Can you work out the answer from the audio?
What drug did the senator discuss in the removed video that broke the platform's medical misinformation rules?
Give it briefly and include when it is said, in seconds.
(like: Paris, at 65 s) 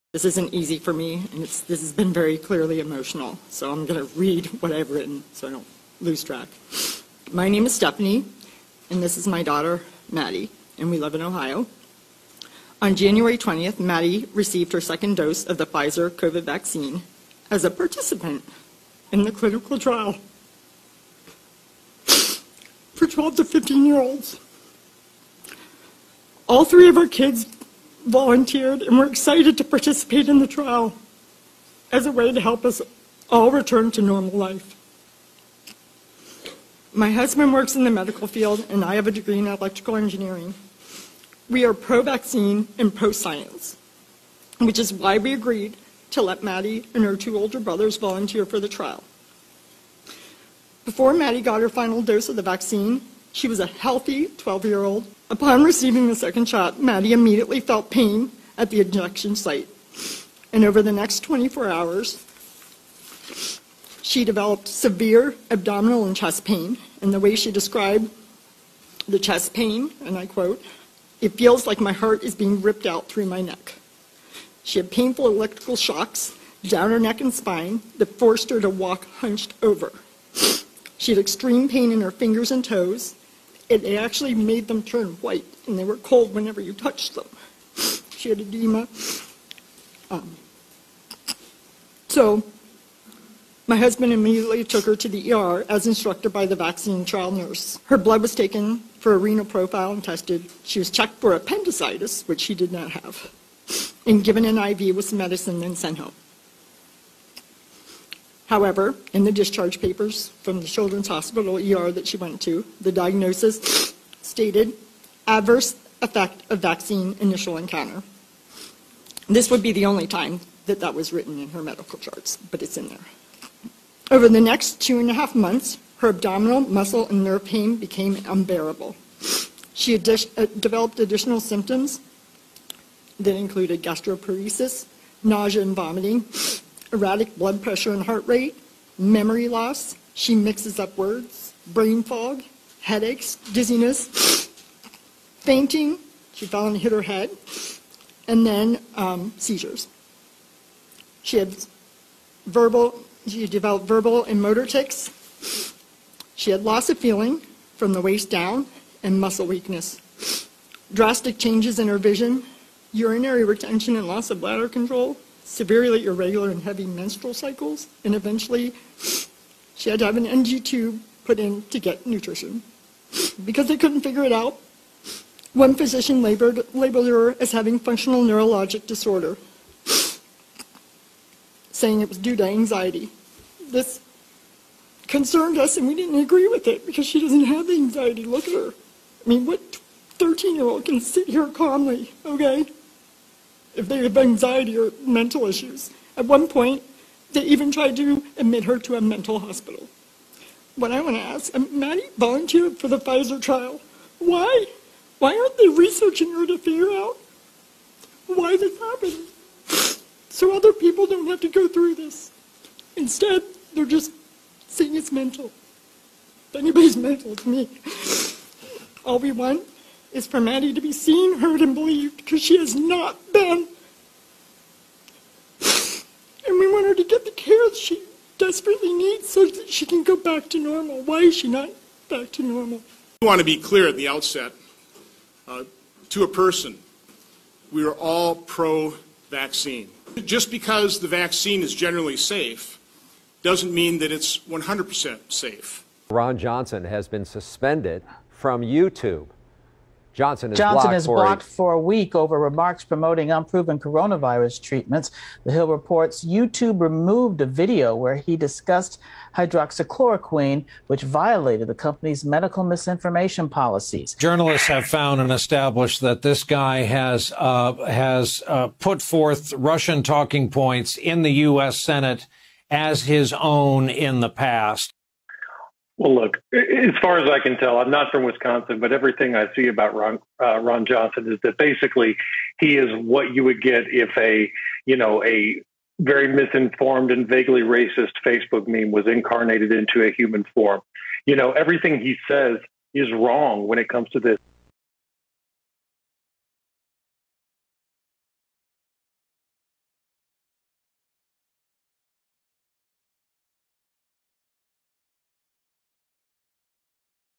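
Hydroxychloroquine, at 259 s.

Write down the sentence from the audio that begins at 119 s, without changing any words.
This would be the only time that that was written in her medical charts, but it's in there.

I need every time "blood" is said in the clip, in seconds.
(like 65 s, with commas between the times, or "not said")
97 s, 137 s.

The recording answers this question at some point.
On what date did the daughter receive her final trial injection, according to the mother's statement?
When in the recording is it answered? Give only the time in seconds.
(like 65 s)
12 s.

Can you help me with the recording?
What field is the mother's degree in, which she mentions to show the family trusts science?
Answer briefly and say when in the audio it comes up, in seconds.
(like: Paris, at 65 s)
Electrical engineering, at 39 s.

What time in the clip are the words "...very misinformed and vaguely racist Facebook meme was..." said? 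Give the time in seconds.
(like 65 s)
285 s.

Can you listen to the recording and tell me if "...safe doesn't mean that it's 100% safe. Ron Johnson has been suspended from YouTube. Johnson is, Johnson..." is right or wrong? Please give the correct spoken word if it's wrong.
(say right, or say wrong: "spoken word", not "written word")
right.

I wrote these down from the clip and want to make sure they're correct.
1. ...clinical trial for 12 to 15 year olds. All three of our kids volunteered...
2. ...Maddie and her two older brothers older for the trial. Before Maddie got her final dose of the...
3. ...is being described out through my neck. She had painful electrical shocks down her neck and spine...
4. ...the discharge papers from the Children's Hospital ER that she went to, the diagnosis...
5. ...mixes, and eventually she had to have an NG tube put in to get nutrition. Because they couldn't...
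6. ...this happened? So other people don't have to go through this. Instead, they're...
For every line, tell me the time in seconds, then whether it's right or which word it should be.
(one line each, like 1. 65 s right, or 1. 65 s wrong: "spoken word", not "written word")
1. 19 s right
2. 46 s wrong: "volunteer", not "older"
3. 72 s wrong: "ripped", not "described"
4. 109 s right
5. 167 s wrong: "cycles", not "mixes"
6. 208 s right.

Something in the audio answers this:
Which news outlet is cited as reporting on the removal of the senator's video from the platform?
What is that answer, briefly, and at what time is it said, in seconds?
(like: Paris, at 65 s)
The Hill, at 255 s.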